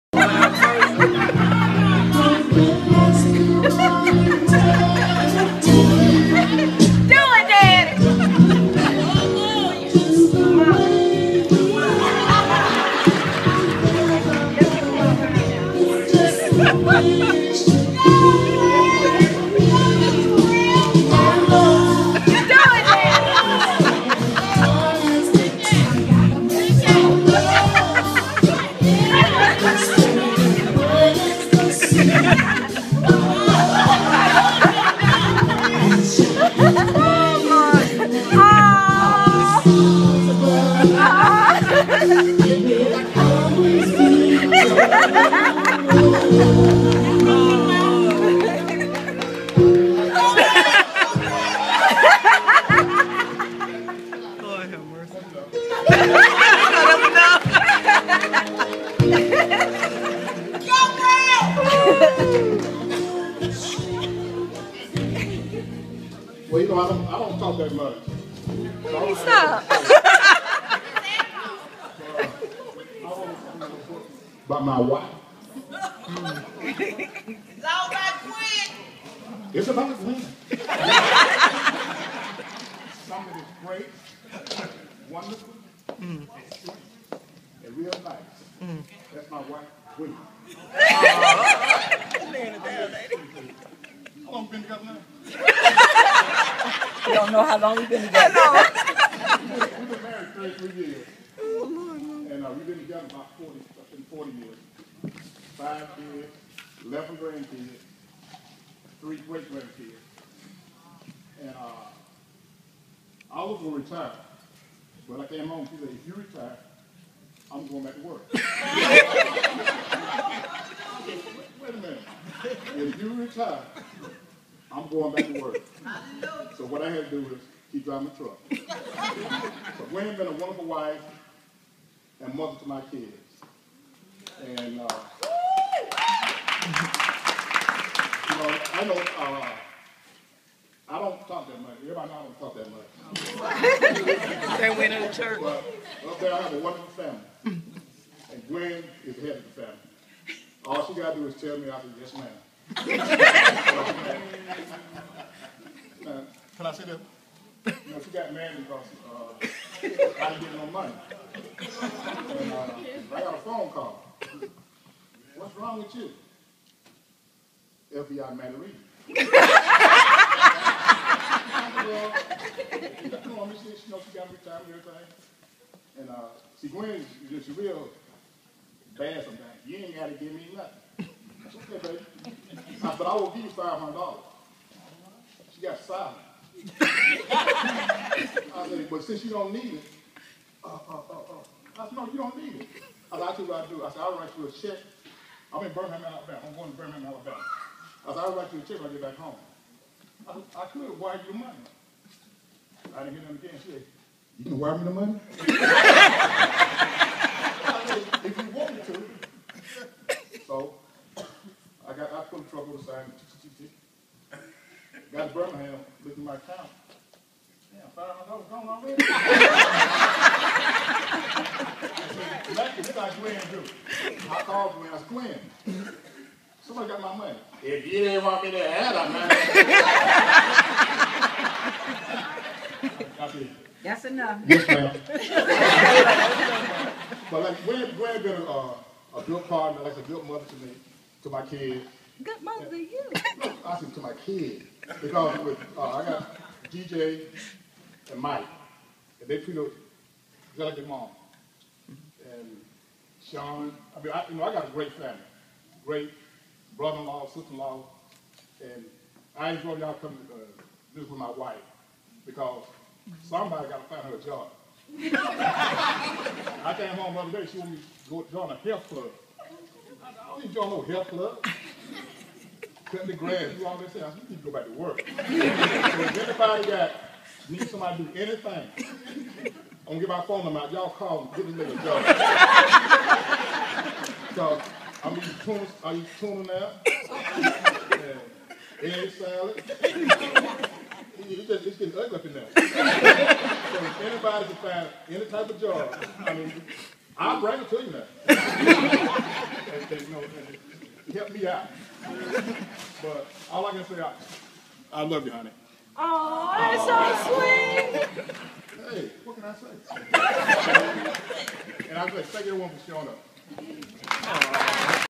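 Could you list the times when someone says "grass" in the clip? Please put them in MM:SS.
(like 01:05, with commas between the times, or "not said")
04:33.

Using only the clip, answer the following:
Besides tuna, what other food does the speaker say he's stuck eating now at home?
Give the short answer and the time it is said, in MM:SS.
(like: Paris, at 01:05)
Egg salad, at 04:48.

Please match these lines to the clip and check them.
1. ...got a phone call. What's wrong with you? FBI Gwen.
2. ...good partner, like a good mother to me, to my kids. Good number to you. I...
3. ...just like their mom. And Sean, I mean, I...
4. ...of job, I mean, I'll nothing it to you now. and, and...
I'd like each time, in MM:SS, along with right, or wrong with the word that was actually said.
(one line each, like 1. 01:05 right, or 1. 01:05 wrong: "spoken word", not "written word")
1. 02:43 wrong: "Mandarin", not "Gwen"
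2. 03:59 wrong: "mother", not "number"
3. 04:09 right
4. 04:55 wrong: "bring", not "nothing".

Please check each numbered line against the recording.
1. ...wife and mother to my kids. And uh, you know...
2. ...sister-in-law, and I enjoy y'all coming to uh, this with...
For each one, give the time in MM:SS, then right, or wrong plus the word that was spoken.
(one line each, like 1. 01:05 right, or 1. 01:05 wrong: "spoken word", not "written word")
1. 02:10 right
2. 04:17 right.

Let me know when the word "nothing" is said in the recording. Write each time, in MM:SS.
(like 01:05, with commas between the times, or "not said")
03:00, 03:42.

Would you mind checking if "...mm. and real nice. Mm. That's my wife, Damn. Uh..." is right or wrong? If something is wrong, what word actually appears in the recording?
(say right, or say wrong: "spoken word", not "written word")
wrong: "Gwen", not "Damn".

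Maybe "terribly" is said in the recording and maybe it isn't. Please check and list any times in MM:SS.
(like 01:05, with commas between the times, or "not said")
not said.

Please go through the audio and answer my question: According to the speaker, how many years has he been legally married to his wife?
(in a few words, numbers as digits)
33 years.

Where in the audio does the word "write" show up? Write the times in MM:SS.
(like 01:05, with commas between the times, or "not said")
03:14, 03:18.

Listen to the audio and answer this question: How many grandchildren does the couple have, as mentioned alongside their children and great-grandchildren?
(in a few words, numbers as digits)
11.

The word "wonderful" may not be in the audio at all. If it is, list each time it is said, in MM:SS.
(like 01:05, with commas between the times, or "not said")
01:25, 02:10, 02:26.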